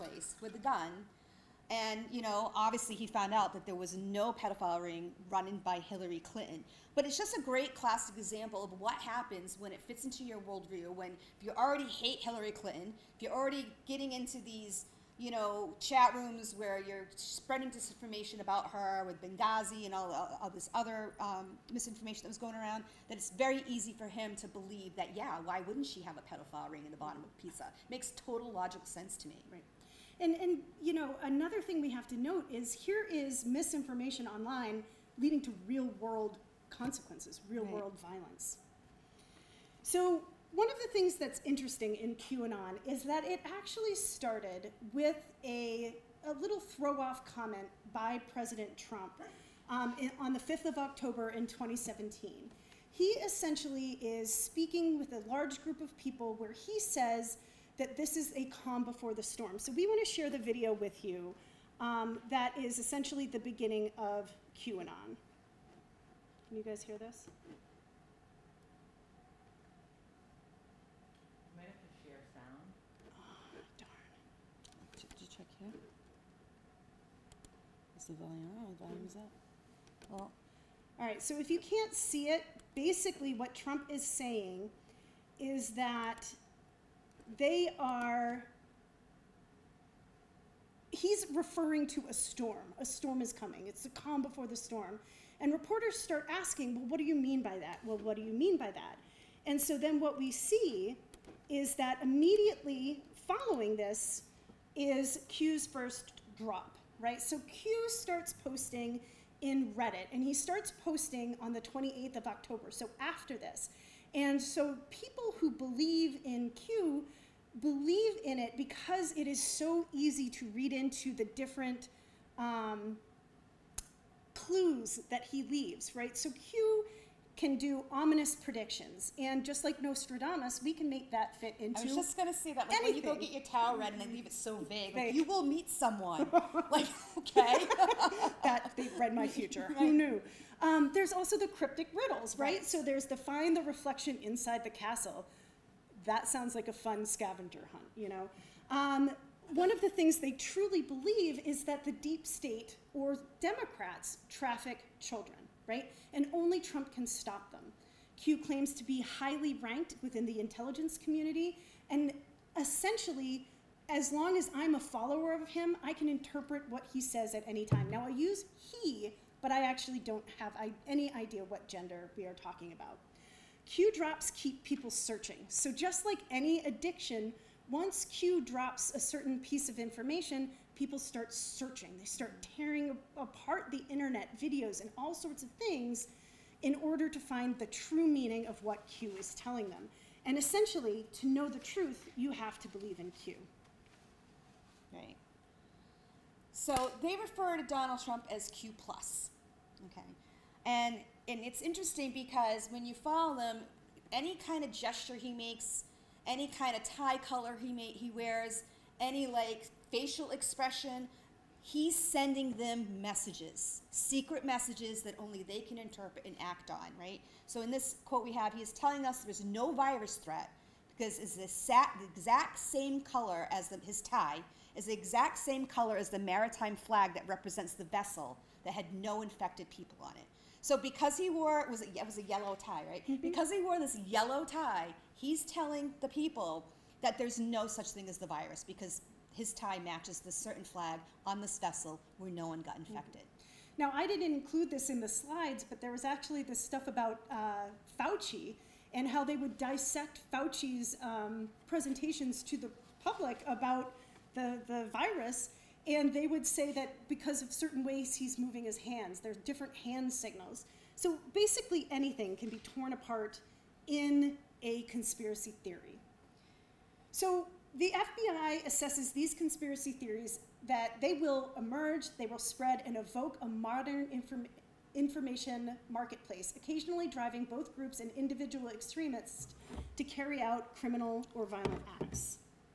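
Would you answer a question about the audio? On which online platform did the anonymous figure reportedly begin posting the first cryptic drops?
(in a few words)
Reddit.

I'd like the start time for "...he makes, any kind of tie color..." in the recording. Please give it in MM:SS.
03:25.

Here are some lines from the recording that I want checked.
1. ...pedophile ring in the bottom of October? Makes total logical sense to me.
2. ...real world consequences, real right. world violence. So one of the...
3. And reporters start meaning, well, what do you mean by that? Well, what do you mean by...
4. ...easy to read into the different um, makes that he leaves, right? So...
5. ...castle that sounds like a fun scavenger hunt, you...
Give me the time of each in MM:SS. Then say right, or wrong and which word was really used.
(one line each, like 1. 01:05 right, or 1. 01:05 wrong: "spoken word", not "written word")
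1. 00:26 wrong: "Pisa", not "October"
2. 00:35 right
3. 01:35 wrong: "asking", not "meaning"
4. 01:59 wrong: "clues", not "makes"
5. 02:24 right.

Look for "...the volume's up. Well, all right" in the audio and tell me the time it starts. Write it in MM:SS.
01:18.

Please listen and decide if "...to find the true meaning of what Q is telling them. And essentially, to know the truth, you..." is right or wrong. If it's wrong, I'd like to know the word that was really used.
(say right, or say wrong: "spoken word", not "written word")
right.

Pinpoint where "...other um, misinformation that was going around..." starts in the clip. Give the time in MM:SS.
00:20.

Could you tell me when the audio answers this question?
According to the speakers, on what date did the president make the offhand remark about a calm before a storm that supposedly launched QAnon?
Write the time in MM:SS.
00:50.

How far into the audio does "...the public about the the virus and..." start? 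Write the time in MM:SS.
04:12.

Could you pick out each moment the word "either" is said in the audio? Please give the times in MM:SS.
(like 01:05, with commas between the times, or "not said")
not said.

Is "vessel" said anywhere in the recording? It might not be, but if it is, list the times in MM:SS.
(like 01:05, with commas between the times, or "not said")
03:47, 04:01.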